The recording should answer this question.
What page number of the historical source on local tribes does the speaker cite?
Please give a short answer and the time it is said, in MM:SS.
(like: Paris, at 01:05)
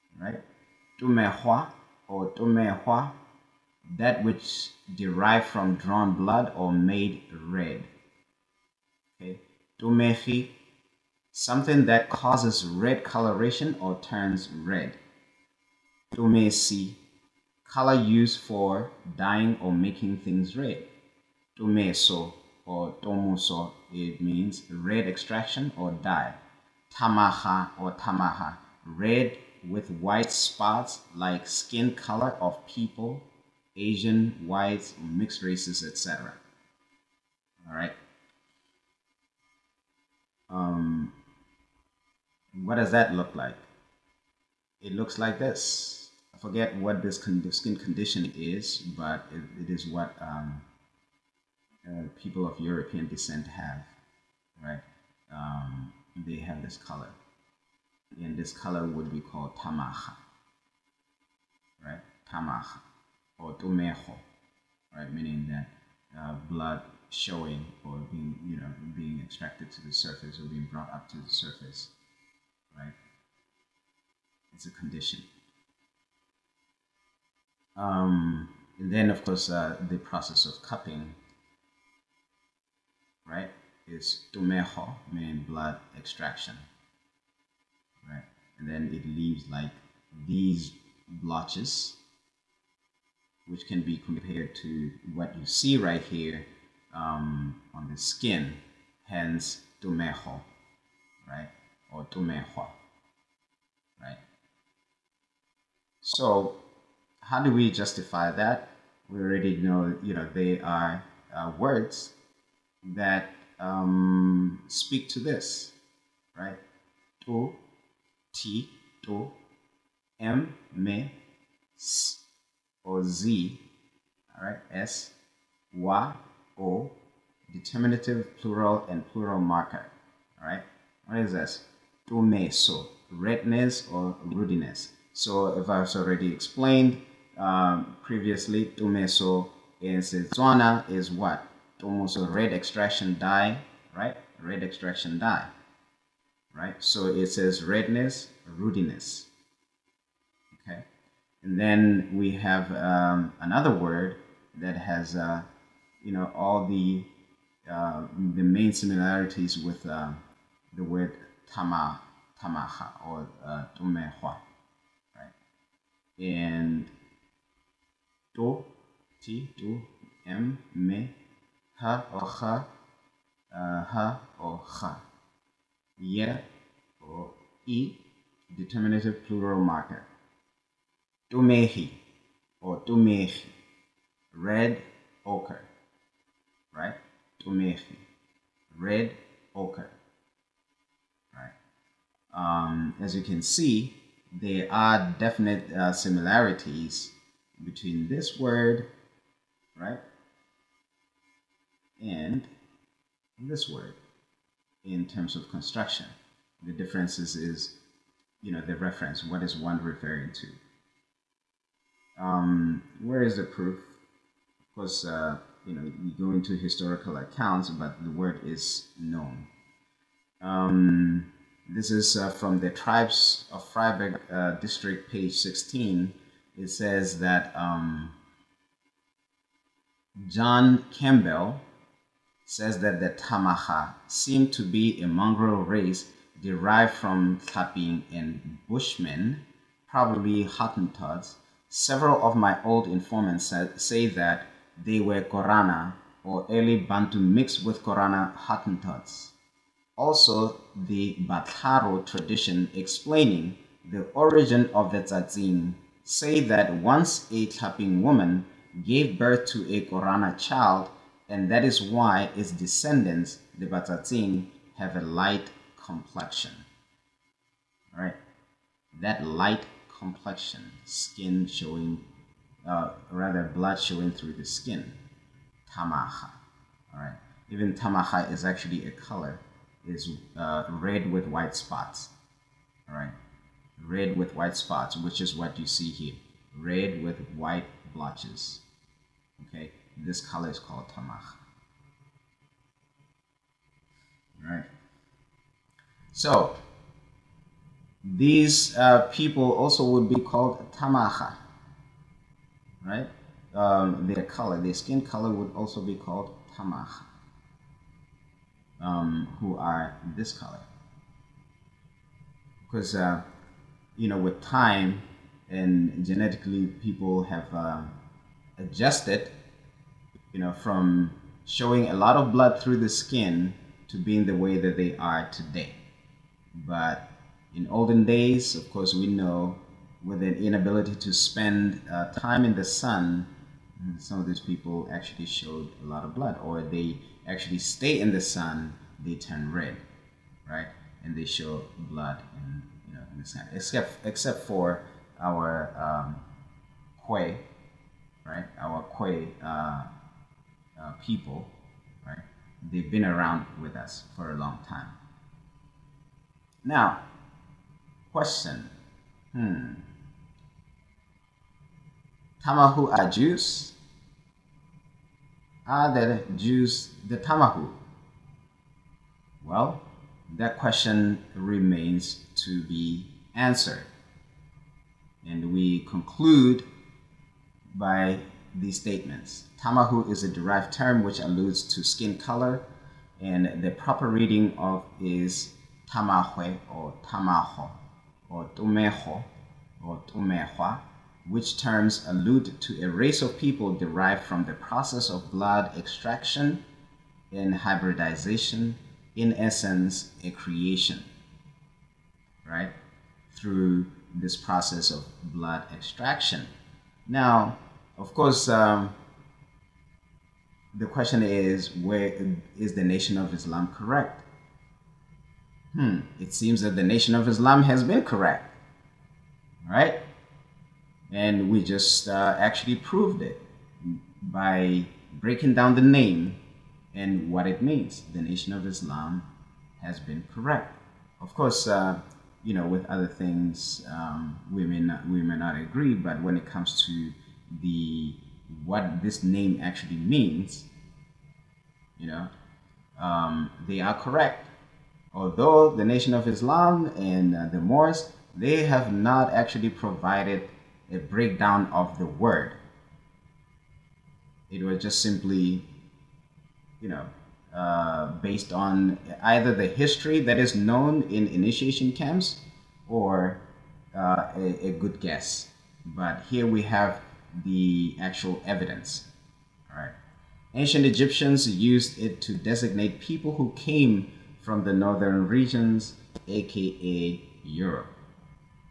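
16, at 03:45.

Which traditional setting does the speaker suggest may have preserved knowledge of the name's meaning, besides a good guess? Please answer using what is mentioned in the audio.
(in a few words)
Initiation camps.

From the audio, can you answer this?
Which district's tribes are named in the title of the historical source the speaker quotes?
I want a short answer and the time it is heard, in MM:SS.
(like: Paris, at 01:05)
Vryburg, at 03:43.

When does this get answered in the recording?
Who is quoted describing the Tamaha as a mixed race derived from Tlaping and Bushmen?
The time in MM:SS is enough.
03:50.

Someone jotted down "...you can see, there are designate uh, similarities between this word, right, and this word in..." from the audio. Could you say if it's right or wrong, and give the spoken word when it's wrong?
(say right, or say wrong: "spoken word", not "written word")
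wrong: "definite", not "designate".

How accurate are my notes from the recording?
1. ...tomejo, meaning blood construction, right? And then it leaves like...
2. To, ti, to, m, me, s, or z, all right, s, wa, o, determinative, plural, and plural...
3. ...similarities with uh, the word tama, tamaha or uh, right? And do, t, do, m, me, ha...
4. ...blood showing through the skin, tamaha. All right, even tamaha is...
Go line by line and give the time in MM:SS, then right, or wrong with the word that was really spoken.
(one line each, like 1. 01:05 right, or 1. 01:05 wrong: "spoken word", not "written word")
1. 01:24 wrong: "extraction", not "construction"
2. 01:57 right
3. 02:38 right
4. 04:33 right.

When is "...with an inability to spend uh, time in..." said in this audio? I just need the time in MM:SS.
05:30.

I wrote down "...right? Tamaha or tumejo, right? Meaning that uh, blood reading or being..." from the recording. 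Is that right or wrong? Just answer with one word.
wrong.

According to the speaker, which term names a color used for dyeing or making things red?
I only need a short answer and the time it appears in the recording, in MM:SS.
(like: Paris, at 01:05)
Tomesi, at 00:16.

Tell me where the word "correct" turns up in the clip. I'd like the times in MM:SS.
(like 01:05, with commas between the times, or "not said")
06:53, 06:58, 07:10, 07:23.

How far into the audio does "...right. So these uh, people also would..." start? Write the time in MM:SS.
04:54.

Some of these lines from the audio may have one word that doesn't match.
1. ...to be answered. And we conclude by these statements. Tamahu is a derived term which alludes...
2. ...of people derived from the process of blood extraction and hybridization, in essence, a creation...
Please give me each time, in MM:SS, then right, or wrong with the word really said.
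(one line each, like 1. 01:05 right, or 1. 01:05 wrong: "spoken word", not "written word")
1. 06:12 right
2. 06:33 right.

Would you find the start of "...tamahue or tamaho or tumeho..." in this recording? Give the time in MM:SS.
06:25.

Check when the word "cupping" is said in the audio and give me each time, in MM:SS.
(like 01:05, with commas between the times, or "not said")
01:20.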